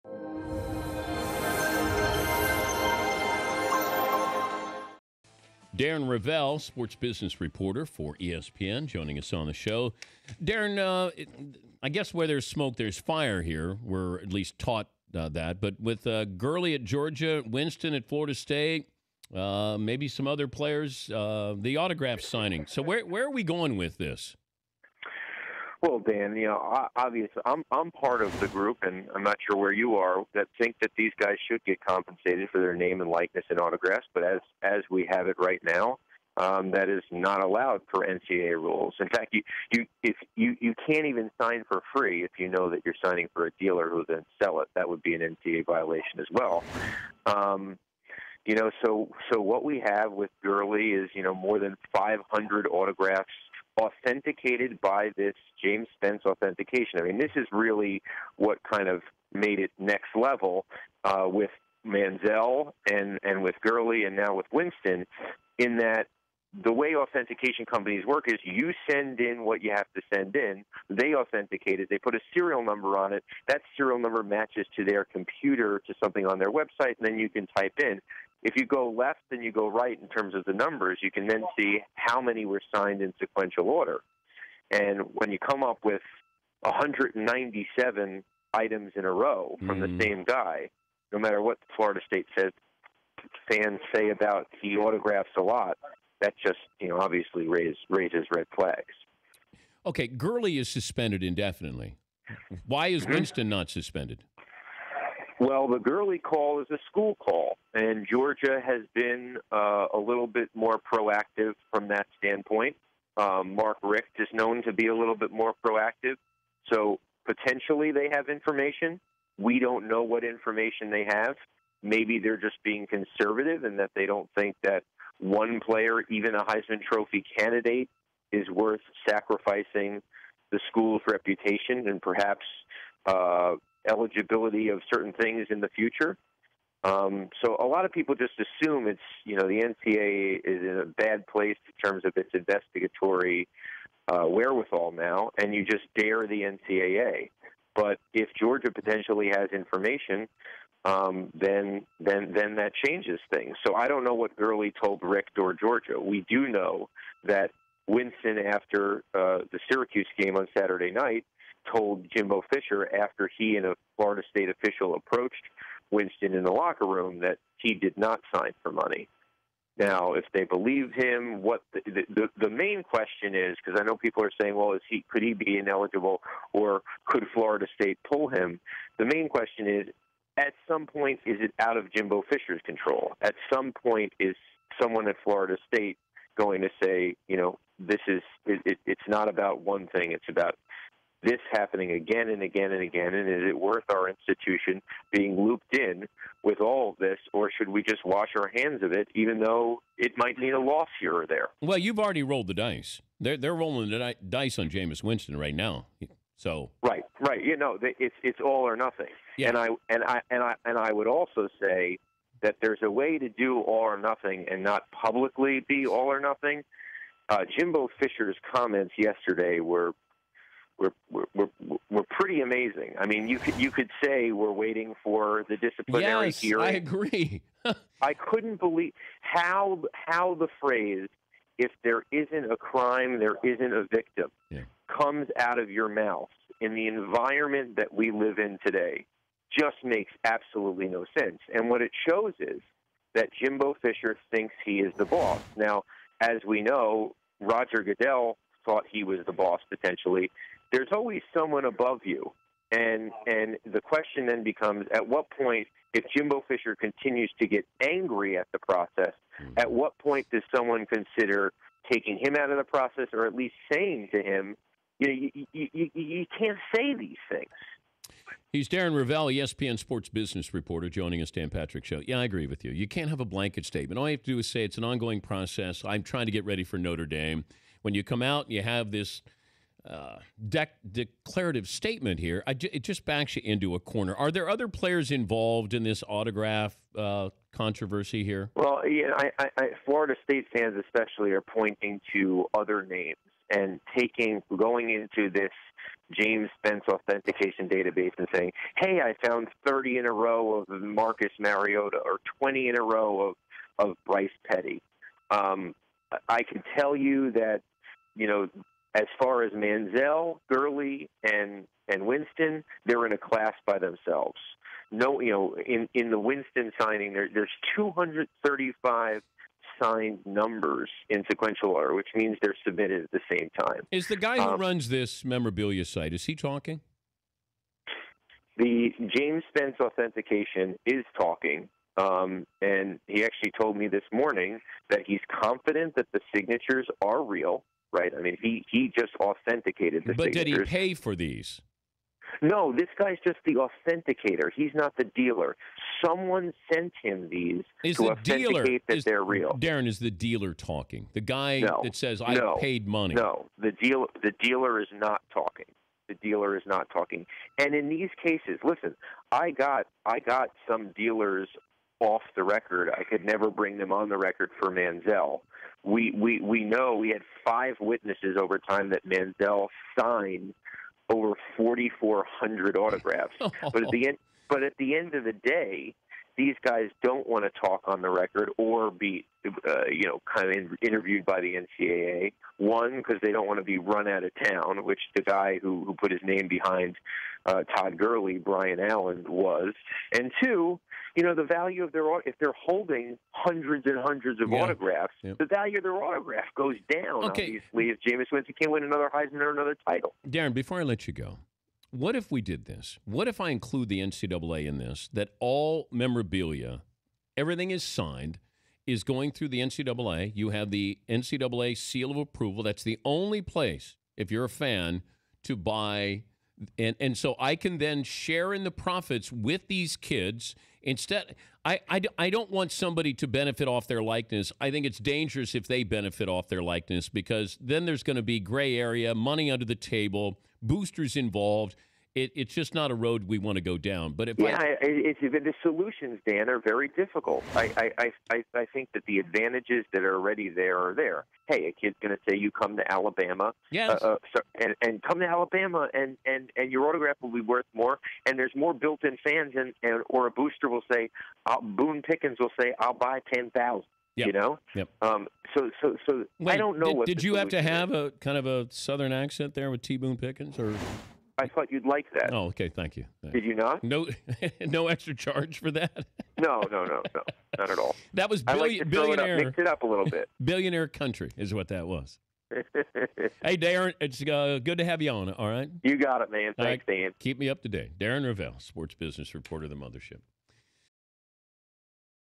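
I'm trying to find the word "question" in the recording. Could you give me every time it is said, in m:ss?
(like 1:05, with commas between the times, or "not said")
2:52, 2:59, 4:13.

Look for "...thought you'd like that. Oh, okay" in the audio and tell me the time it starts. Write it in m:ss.
7:41.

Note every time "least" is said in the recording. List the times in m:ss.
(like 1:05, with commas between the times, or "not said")
0:14, 4:23.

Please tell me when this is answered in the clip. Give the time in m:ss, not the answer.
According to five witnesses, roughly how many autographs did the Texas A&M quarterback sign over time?
6:11.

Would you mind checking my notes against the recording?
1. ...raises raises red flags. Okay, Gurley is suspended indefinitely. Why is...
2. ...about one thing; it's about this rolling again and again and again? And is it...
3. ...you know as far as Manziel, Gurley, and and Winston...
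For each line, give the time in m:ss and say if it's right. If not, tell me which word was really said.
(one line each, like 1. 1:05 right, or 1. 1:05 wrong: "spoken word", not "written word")
1. 1:37 right
2. 3:09 wrong: "happening", not "rolling"
3. 5:08 right.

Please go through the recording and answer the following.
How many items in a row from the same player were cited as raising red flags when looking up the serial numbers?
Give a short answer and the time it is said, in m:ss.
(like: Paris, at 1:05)
197, at 1:26.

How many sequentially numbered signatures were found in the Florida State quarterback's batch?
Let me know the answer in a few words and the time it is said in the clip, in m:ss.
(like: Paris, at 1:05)
235, at 5:17.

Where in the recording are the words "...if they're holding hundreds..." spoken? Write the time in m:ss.
6:32.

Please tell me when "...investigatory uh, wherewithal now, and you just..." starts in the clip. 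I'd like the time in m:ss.
2:22.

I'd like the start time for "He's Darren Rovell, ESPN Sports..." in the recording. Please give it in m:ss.
4:28.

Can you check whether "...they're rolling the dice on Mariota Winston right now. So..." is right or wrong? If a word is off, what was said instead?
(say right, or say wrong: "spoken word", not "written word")
wrong: "Jameis", not "Mariota".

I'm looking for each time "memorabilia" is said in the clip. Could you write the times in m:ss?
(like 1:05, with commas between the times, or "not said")
5:25, 6:45.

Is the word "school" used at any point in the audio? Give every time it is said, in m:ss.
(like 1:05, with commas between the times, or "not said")
1:46, 2:10.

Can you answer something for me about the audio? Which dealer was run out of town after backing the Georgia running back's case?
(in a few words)
Brian Allen.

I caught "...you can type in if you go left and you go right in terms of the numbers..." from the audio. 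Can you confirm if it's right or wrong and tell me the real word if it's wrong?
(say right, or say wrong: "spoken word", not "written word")
right.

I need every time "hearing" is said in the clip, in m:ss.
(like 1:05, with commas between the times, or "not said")
3:46.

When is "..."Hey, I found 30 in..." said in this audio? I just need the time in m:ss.
4:58.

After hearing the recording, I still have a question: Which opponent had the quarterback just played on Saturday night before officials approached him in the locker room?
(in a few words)
Syracuse.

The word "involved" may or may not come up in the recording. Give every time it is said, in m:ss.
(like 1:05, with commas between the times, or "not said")
4:45, 7:11.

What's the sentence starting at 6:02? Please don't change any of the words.
I could never bring them on the record for Manziel.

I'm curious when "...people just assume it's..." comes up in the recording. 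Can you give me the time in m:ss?
2:17.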